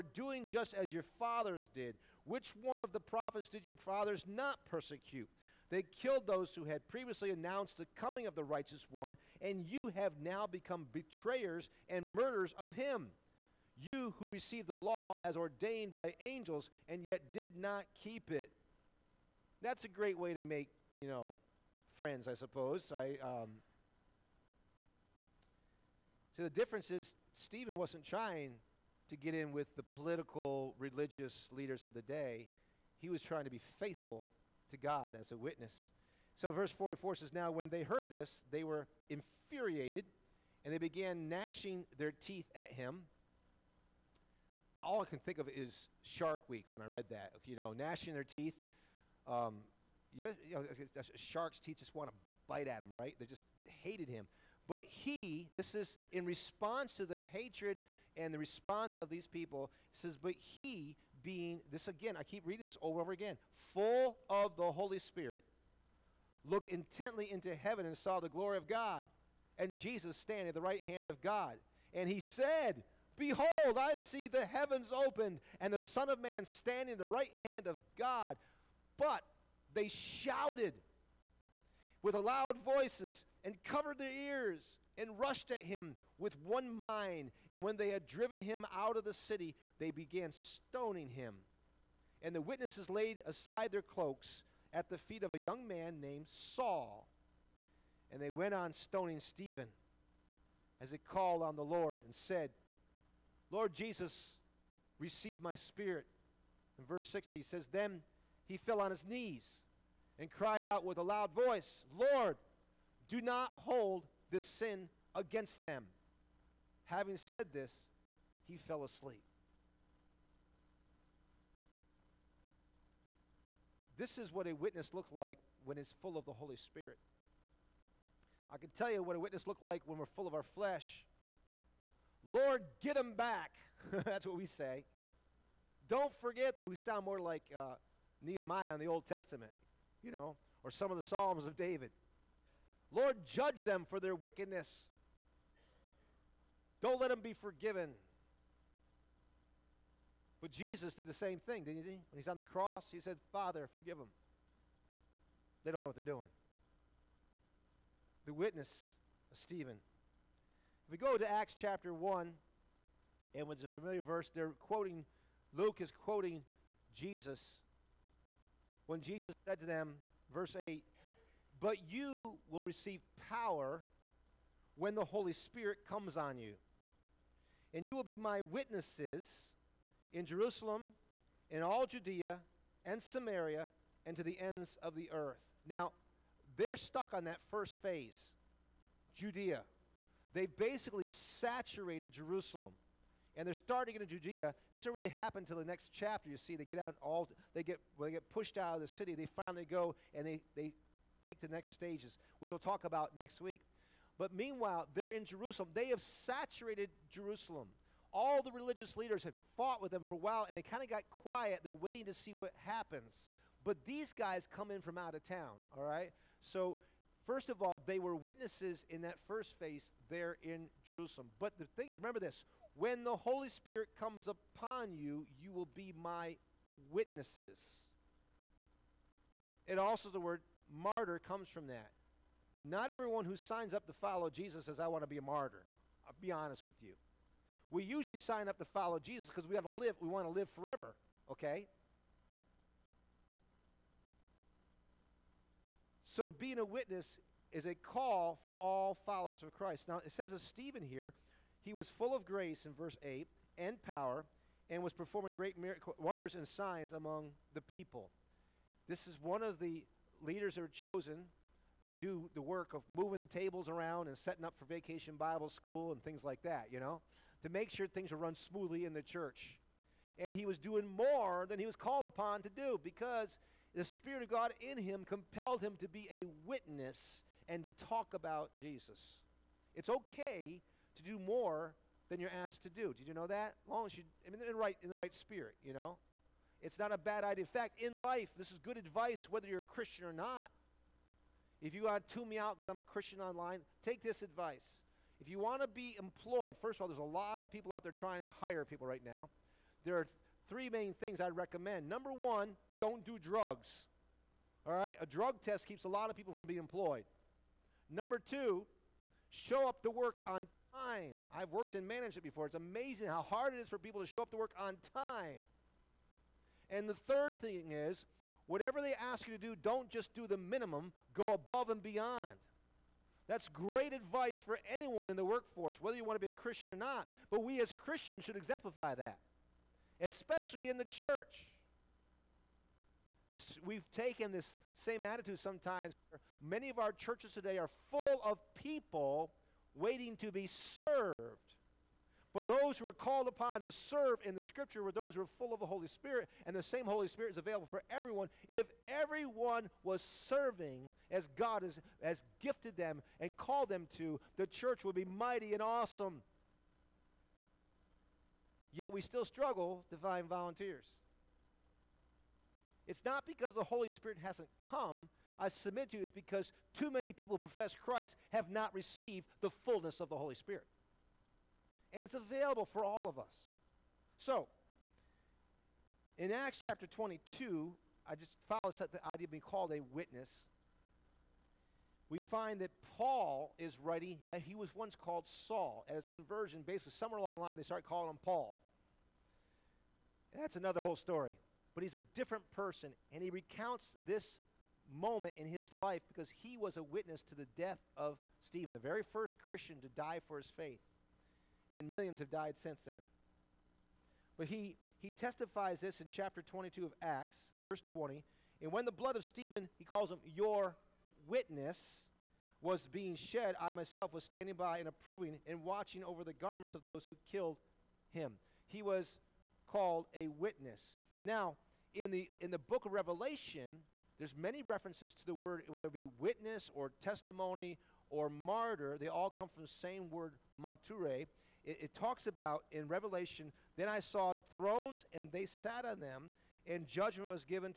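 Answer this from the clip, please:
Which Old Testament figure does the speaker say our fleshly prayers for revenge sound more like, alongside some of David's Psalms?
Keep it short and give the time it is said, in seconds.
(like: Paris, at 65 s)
Nehemiah, at 138 s.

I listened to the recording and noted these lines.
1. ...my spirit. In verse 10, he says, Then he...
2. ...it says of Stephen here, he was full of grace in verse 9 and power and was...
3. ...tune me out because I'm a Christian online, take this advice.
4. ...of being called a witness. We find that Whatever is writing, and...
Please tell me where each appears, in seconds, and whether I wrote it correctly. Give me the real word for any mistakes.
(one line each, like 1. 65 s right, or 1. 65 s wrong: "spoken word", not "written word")
1. 105 s wrong: "60", not "10"
2. 250 s wrong: "8", not "9"
3. 292 s right
4. 379 s wrong: "Paul", not "Whatever".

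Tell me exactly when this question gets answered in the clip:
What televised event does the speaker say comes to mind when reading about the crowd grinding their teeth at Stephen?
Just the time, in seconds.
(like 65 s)
46 s.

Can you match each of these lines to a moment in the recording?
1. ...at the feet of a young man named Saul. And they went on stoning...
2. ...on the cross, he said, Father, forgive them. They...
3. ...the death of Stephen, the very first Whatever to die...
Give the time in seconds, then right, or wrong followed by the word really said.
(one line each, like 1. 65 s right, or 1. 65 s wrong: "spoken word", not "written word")
1. 94 s right
2. 152 s right
3. 397 s wrong: "Christian", not "Whatever".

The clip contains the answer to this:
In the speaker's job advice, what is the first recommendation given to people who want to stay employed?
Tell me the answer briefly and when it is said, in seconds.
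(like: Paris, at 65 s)
Don't do drugs, at 302 s.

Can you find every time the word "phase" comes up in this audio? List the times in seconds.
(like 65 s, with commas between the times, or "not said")
187 s, 219 s.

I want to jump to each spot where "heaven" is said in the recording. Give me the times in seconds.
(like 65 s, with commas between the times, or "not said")
67 s, 74 s.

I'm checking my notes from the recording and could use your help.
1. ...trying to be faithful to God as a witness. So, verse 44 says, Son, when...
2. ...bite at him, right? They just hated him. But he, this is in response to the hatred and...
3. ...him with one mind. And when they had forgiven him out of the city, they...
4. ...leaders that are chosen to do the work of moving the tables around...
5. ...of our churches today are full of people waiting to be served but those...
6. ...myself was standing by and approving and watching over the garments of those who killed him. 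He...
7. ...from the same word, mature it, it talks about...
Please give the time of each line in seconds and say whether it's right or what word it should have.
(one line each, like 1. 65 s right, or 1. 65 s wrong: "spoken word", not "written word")
1. 33 s wrong: "Now", not "Son"
2. 52 s right
3. 85 s wrong: "driven", not "forgiven"
4. 260 s right
5. 336 s right
6. 413 s right
7. 429 s right.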